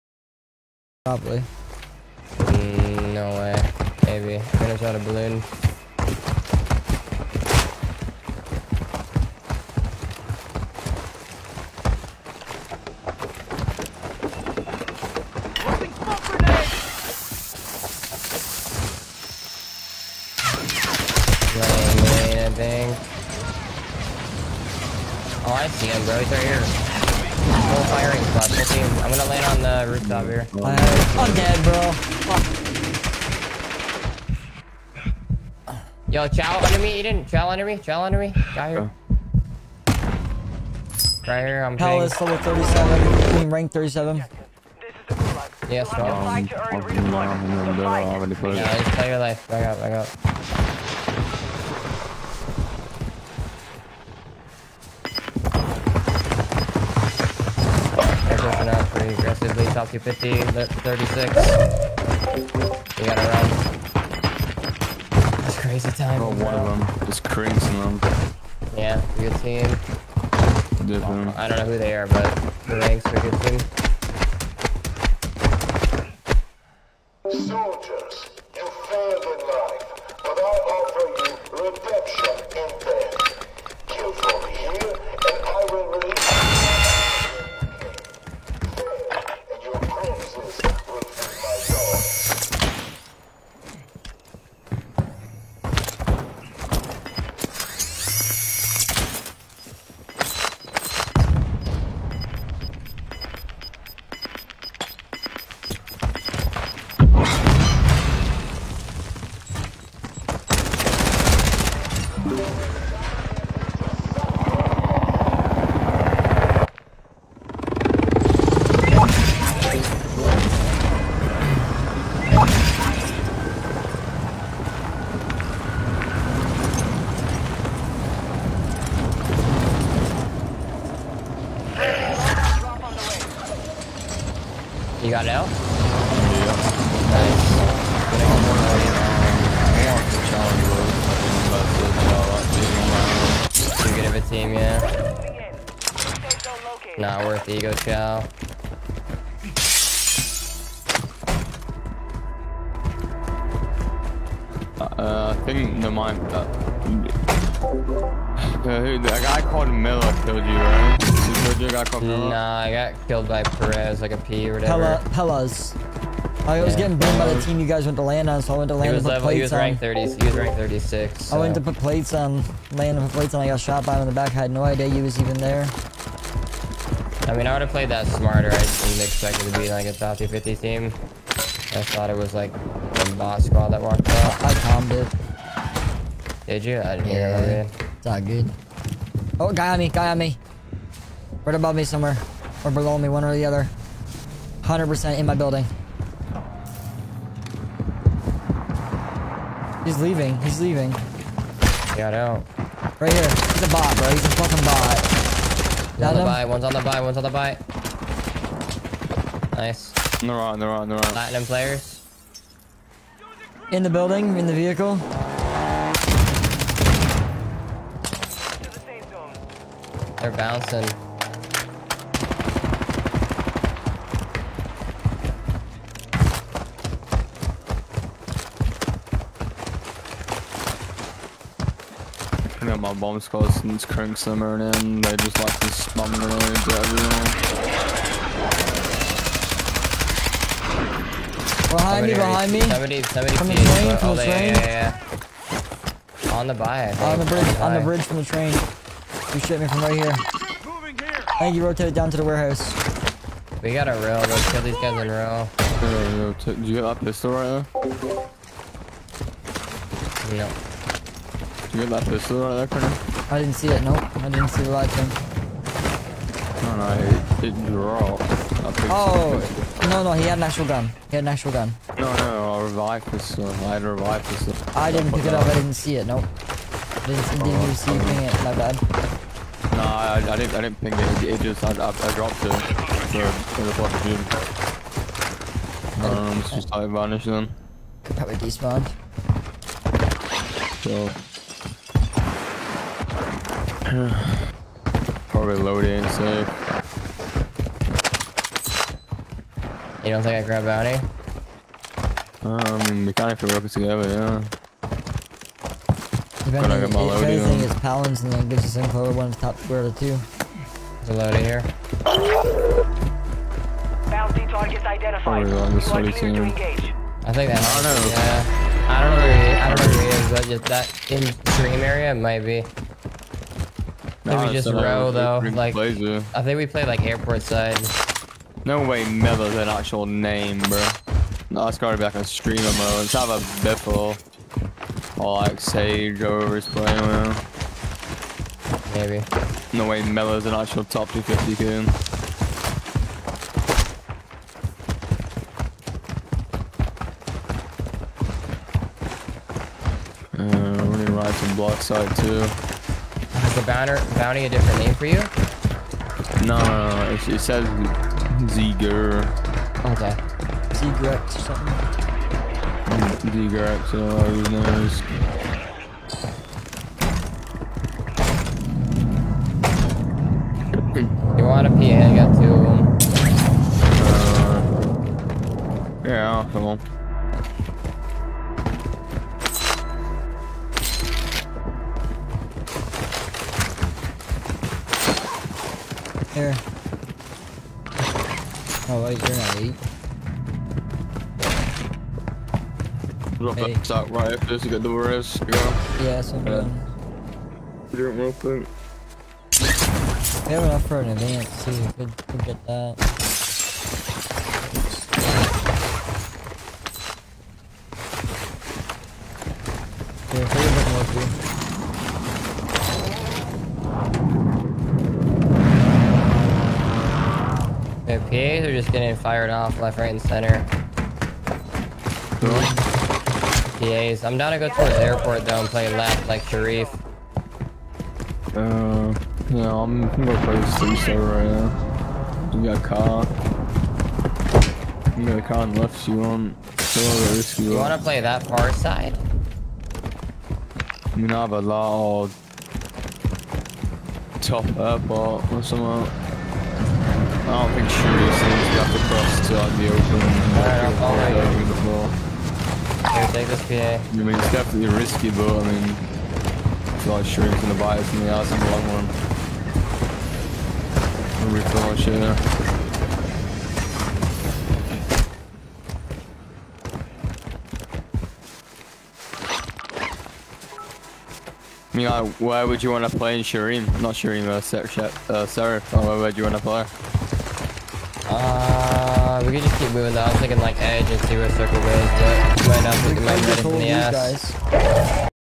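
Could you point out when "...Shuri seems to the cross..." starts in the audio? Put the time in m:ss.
7:27.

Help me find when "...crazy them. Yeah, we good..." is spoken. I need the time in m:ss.
1:07.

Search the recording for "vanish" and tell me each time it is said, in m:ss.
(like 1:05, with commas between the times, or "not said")
4:46.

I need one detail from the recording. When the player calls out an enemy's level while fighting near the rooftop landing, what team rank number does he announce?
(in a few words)
37.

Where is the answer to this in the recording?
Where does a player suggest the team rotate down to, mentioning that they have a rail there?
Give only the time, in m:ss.
4:12.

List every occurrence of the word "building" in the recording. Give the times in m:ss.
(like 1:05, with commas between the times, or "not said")
3:15, 3:33.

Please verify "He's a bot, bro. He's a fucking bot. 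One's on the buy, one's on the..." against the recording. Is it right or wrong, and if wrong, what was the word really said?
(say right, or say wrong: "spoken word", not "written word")
right.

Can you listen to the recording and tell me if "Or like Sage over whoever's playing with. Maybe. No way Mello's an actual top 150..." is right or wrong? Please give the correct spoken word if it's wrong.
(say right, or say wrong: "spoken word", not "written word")
wrong: "250", not "150".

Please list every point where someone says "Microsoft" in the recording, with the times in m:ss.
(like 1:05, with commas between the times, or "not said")
not said.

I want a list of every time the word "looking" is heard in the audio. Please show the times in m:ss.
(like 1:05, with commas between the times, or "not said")
not said.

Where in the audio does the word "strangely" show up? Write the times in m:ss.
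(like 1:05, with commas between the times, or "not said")
not said.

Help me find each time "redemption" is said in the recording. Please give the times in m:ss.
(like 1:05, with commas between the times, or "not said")
1:21.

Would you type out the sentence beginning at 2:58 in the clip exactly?
I didn't expect it to be like a top 50 team.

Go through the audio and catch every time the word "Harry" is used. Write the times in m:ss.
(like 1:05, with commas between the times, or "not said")
not said.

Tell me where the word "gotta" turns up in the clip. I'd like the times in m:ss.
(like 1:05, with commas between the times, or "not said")
1:03, 5:31.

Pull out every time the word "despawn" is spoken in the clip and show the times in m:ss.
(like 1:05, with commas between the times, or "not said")
4:48.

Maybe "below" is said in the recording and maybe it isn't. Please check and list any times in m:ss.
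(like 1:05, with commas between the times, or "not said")
3:12.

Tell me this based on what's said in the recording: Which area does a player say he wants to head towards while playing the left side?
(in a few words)
the airport.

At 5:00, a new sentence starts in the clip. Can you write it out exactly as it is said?
You don't think I grab bounty?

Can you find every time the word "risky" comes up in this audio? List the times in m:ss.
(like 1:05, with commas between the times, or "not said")
7:17, 7:34.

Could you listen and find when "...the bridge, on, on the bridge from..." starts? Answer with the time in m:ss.
4:07.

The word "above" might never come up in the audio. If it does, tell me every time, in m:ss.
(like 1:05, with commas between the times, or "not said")
3:11.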